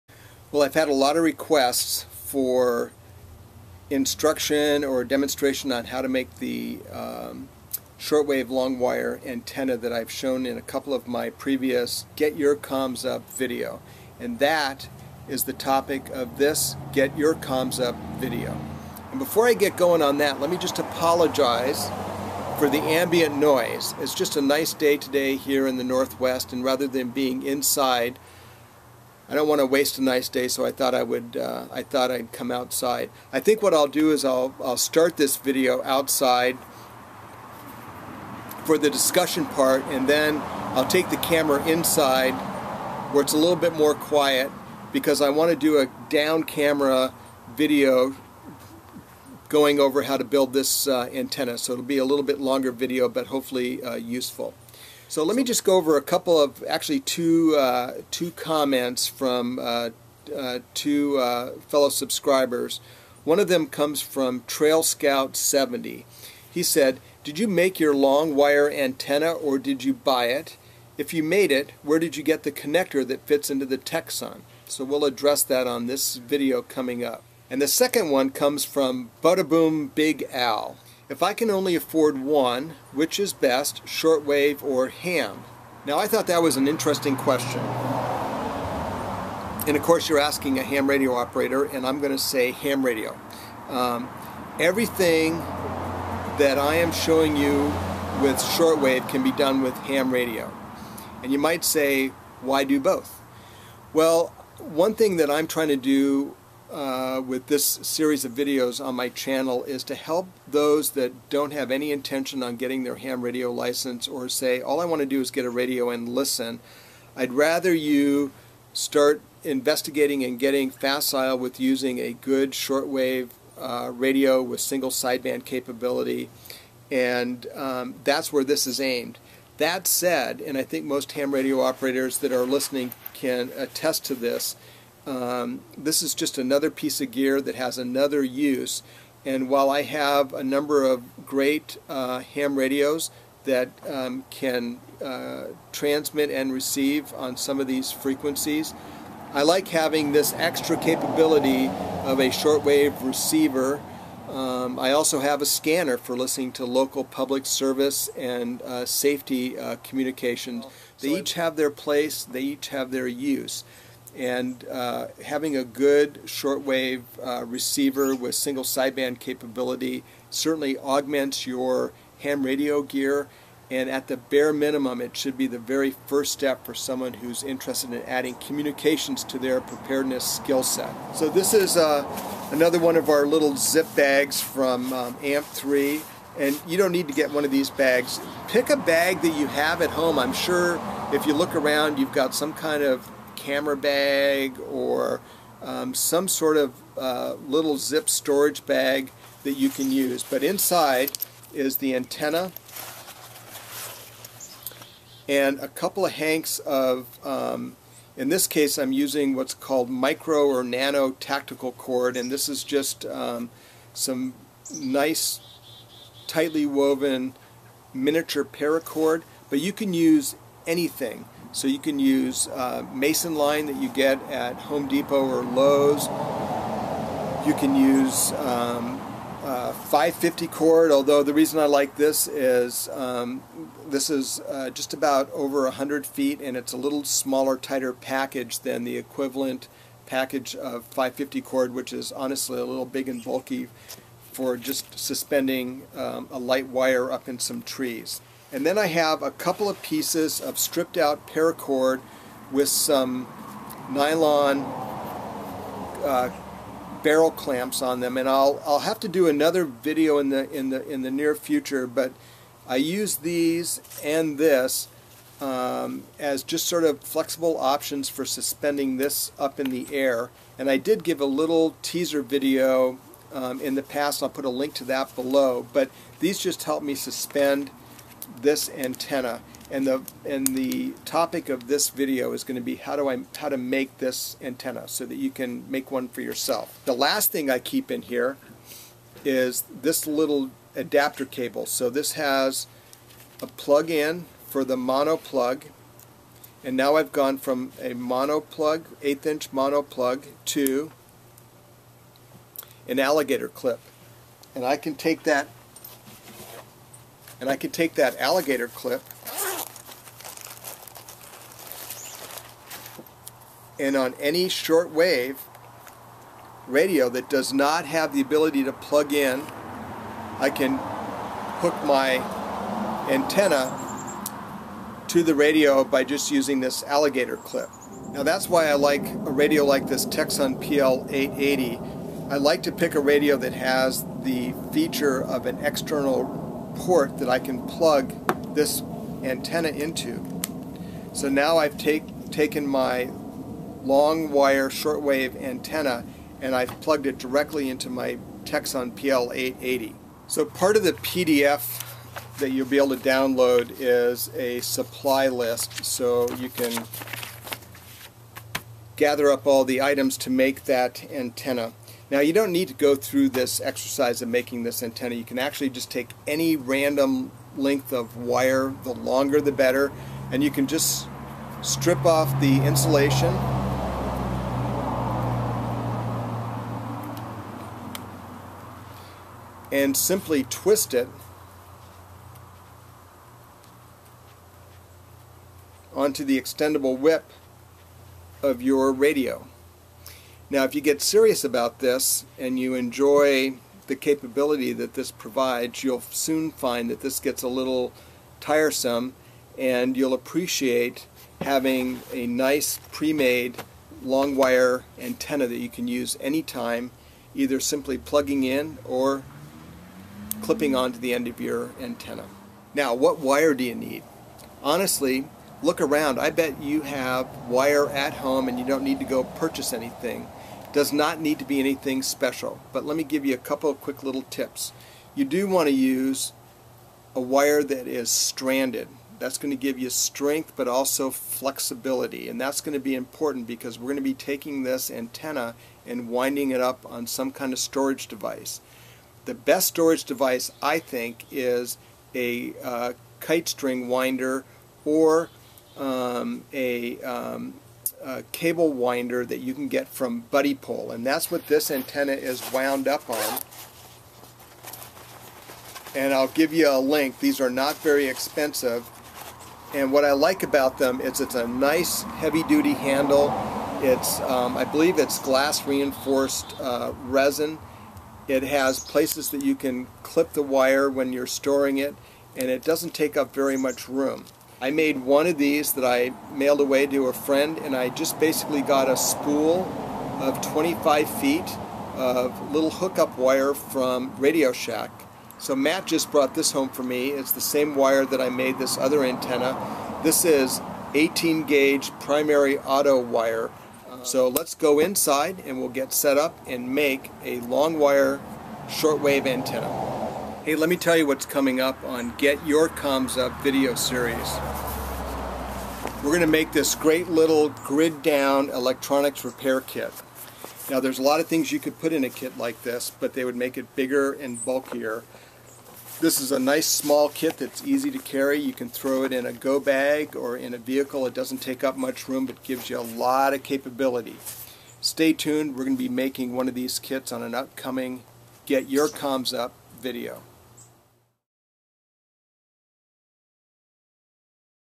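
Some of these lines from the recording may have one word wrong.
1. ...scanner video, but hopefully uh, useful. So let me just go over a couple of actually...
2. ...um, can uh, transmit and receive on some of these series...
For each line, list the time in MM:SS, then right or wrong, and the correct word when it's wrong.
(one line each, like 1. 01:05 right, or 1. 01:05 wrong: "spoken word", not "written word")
1. 00:52 wrong: "longer", not "scanner"
2. 02:23 wrong: "frequencies", not "series".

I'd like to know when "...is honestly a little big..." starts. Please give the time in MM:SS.
04:01.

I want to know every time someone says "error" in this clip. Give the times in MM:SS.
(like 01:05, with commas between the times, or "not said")
not said.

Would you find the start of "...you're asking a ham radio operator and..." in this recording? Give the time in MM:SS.
01:30.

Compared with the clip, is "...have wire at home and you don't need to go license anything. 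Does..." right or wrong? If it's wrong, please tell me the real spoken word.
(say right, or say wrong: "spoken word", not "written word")
wrong: "purchase", not "license".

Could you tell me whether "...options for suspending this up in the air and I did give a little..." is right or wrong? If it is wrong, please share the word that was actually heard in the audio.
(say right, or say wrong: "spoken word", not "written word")
right.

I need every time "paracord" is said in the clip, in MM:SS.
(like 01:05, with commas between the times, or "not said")
03:38, 04:11.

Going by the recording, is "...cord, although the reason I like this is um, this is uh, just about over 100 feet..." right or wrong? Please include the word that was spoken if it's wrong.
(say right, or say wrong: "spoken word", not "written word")
right.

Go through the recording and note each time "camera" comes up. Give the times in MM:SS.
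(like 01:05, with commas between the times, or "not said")
00:41, 00:46, 03:13.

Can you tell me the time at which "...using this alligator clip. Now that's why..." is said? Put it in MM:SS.
05:26.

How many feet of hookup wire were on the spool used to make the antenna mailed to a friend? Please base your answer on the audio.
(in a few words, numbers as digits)
25.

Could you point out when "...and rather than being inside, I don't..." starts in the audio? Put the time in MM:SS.
00:26.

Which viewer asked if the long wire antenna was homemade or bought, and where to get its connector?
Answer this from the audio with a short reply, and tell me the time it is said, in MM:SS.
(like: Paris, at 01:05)
Trail Scout 70, at 01:04.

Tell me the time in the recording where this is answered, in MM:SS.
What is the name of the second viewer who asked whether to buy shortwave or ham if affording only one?
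01:19.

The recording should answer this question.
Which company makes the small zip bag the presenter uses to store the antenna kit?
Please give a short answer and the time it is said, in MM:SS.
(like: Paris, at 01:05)
AMP3, at 03:05.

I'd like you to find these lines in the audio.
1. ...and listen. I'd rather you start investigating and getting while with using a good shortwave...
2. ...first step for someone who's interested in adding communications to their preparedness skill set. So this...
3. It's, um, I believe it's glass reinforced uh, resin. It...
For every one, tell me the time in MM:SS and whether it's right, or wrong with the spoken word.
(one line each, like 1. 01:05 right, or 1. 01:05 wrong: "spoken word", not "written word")
1. 01:55 wrong: "facile", not "while"
2. 02:56 right
3. 07:43 right.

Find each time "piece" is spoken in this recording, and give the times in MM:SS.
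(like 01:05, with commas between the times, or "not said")
02:16, 04:09.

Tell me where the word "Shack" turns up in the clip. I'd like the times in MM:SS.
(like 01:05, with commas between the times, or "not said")
08:04.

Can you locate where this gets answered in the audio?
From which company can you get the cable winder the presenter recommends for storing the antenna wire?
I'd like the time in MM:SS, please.
07:30.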